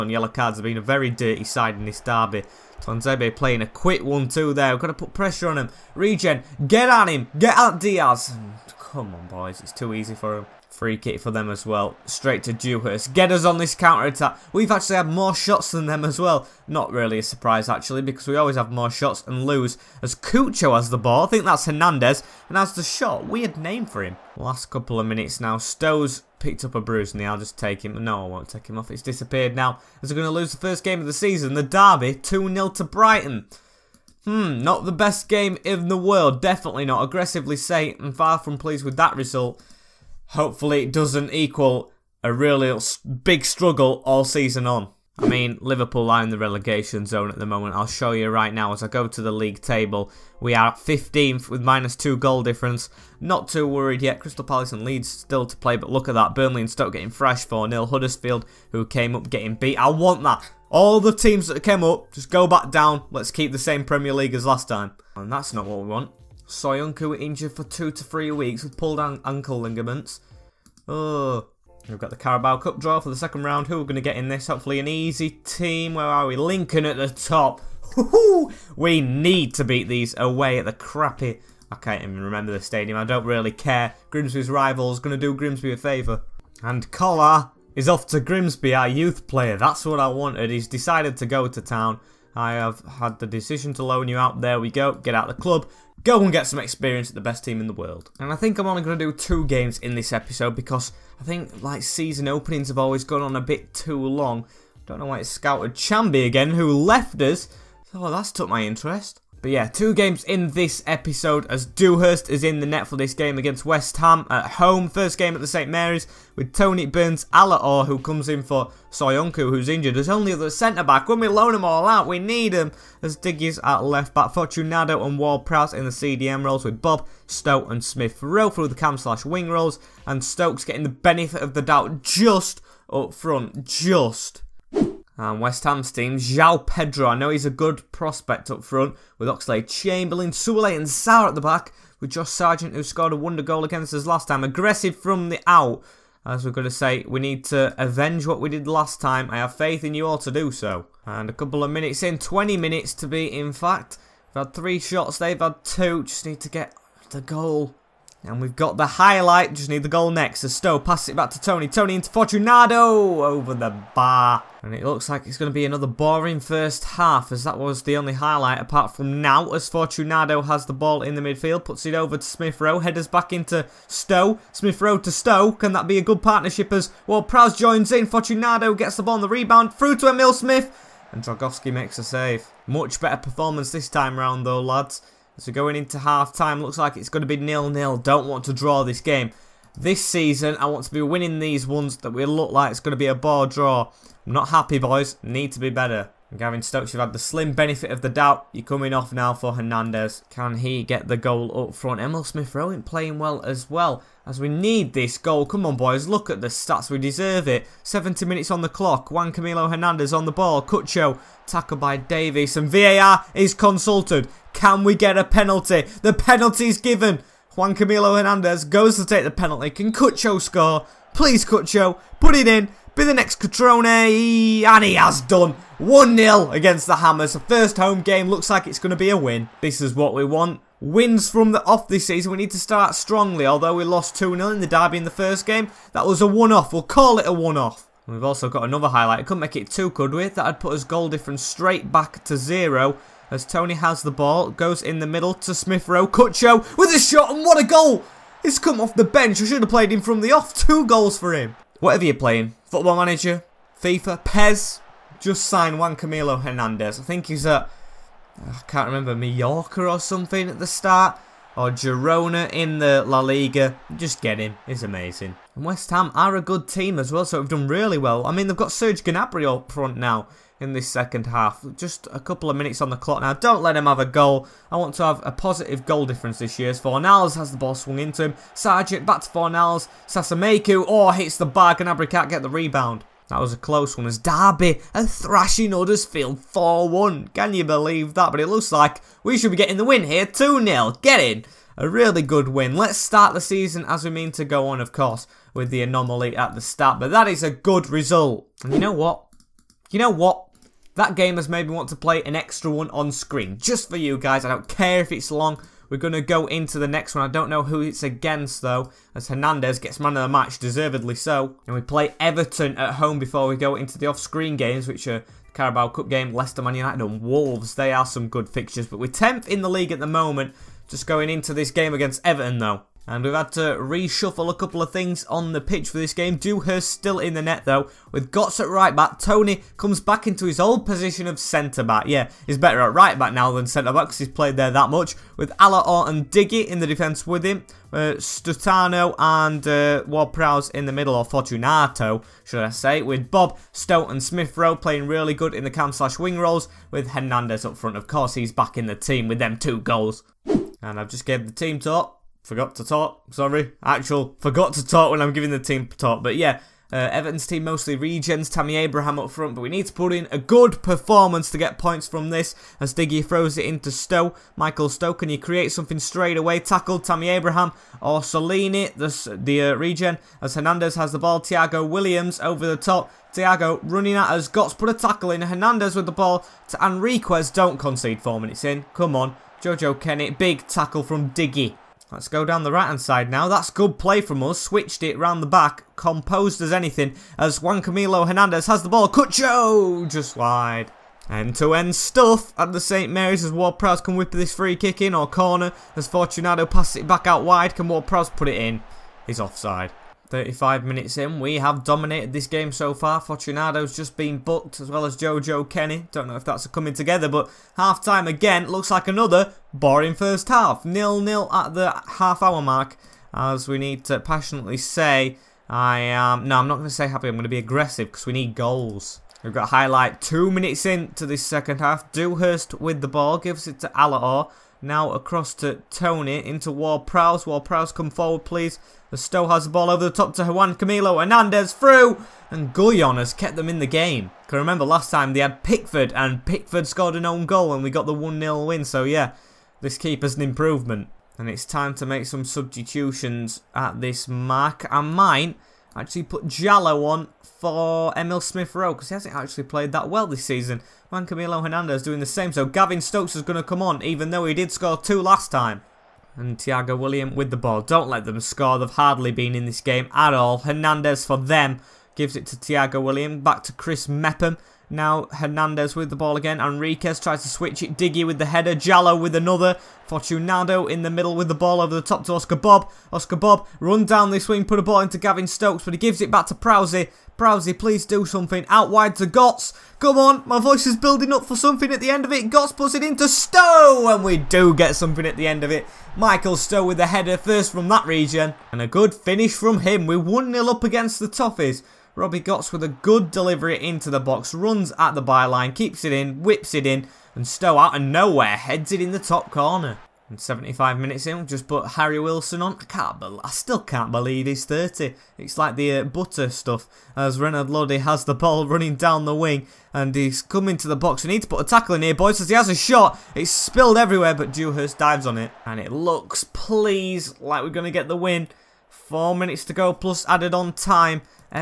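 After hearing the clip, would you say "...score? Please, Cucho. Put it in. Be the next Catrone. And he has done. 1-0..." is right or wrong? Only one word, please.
right.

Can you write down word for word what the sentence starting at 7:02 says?
Dewhurst with the ball, gives it to Alaor.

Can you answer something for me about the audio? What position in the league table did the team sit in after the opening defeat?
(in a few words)
15th.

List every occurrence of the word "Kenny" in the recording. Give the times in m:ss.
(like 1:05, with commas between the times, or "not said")
6:19, 6:45.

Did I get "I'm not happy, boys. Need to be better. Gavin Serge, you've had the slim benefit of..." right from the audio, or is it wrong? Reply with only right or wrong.
wrong.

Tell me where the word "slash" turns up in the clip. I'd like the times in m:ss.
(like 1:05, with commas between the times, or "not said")
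2:08, 5:45.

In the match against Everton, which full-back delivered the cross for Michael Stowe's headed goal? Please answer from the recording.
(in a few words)
Robbie Gotts.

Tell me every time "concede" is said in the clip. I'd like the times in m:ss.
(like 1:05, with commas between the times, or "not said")
6:17.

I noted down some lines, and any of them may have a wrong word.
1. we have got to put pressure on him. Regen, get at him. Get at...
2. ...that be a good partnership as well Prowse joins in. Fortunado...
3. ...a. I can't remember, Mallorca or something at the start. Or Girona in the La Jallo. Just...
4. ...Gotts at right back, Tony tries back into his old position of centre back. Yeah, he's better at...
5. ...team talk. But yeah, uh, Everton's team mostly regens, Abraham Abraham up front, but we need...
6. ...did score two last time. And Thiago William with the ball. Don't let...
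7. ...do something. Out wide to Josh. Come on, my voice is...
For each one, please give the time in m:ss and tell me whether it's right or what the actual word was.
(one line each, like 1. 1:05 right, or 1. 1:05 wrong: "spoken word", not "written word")
1. 0:04 right
2. 2:55 right
3. 4:17 wrong: "Liga", not "Jallo"
4. 5:28 wrong: "comes", not "tries"
5. 5:55 wrong: "Tammy", not "Abraham"
6. 7:34 right
7. 7:58 wrong: "Gotts", not "Josh".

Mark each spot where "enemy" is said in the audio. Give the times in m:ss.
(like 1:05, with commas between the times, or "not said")
not said.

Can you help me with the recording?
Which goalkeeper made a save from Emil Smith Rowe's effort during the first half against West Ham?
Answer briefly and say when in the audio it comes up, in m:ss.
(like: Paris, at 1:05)
Dragowski, at 3:01.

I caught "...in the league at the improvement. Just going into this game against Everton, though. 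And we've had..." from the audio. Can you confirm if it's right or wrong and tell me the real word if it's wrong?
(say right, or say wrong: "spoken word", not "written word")
wrong: "moment", not "improvement".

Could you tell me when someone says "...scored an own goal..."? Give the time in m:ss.
7:16.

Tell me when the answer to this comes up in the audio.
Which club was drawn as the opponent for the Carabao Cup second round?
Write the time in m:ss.
1:16.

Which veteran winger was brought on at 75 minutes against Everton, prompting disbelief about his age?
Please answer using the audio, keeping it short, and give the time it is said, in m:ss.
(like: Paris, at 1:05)
Harry Wilson, at 8:21.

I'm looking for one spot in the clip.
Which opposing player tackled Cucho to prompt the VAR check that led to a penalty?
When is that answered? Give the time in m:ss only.
3:31.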